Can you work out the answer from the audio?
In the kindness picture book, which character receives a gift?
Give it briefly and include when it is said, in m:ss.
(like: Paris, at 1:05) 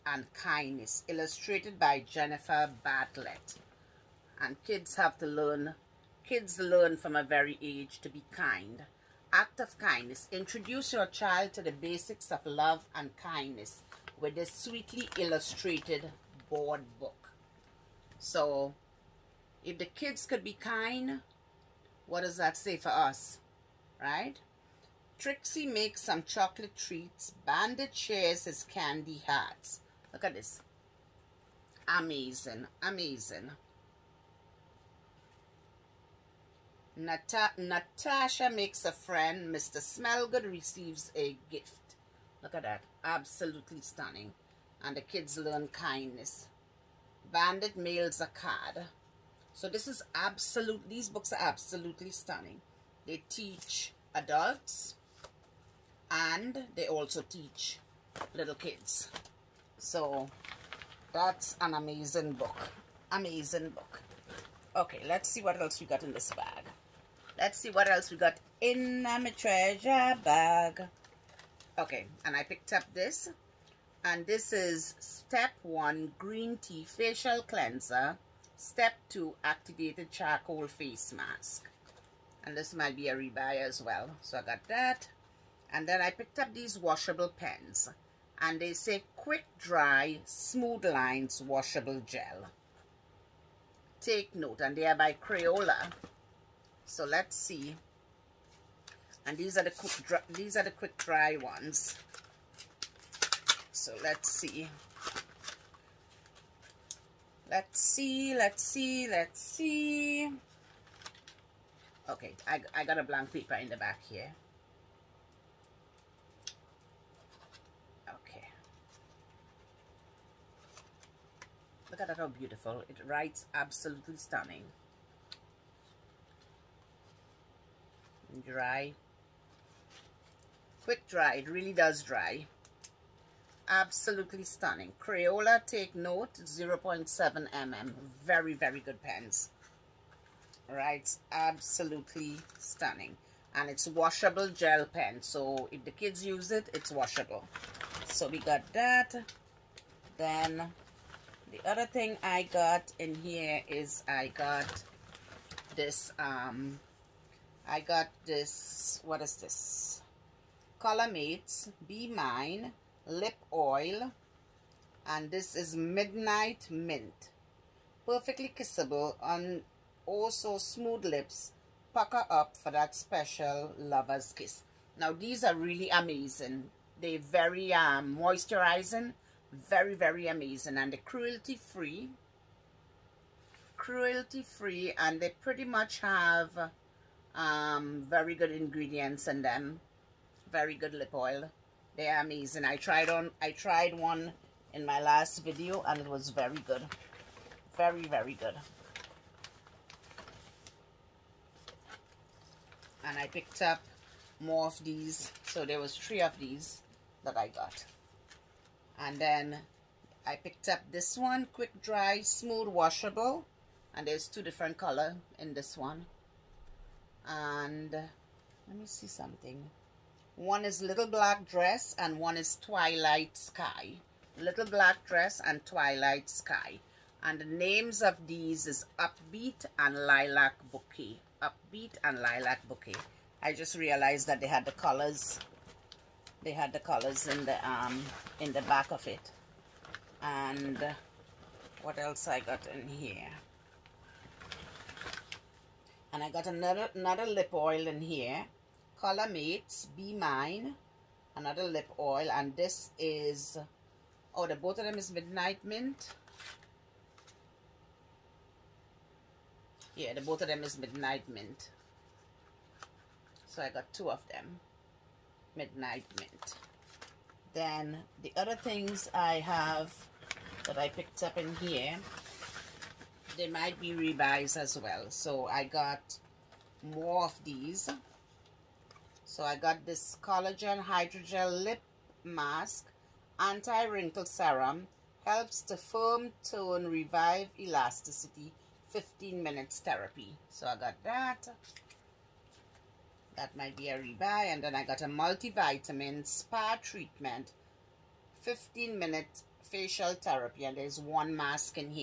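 Mr. Smellgood, at 0:39.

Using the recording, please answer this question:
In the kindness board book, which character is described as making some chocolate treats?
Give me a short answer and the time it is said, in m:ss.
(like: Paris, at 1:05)
Trixie, at 0:25.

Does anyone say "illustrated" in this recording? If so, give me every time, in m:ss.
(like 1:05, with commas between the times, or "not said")
0:01, 0:15.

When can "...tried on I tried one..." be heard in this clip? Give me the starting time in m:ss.
3:12.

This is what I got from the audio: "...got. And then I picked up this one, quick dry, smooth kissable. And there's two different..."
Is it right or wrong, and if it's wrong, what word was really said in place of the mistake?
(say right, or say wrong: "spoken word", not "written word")
wrong: "washable", not "kissable".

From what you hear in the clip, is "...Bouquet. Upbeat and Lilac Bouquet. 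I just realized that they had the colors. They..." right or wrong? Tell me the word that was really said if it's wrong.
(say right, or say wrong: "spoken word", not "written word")
right.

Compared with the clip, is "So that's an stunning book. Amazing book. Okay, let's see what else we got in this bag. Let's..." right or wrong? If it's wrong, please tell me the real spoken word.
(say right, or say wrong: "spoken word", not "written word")
wrong: "amazing", not "stunning".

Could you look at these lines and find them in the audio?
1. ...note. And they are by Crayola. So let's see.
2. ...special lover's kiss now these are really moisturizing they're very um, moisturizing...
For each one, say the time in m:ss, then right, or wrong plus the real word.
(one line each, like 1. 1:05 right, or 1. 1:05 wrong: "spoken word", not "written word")
1. 1:34 right
2. 2:52 wrong: "amazing", not "moisturizing".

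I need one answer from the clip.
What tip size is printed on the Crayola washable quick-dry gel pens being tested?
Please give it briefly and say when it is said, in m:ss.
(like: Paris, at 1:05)
0.7 mm, at 2:16.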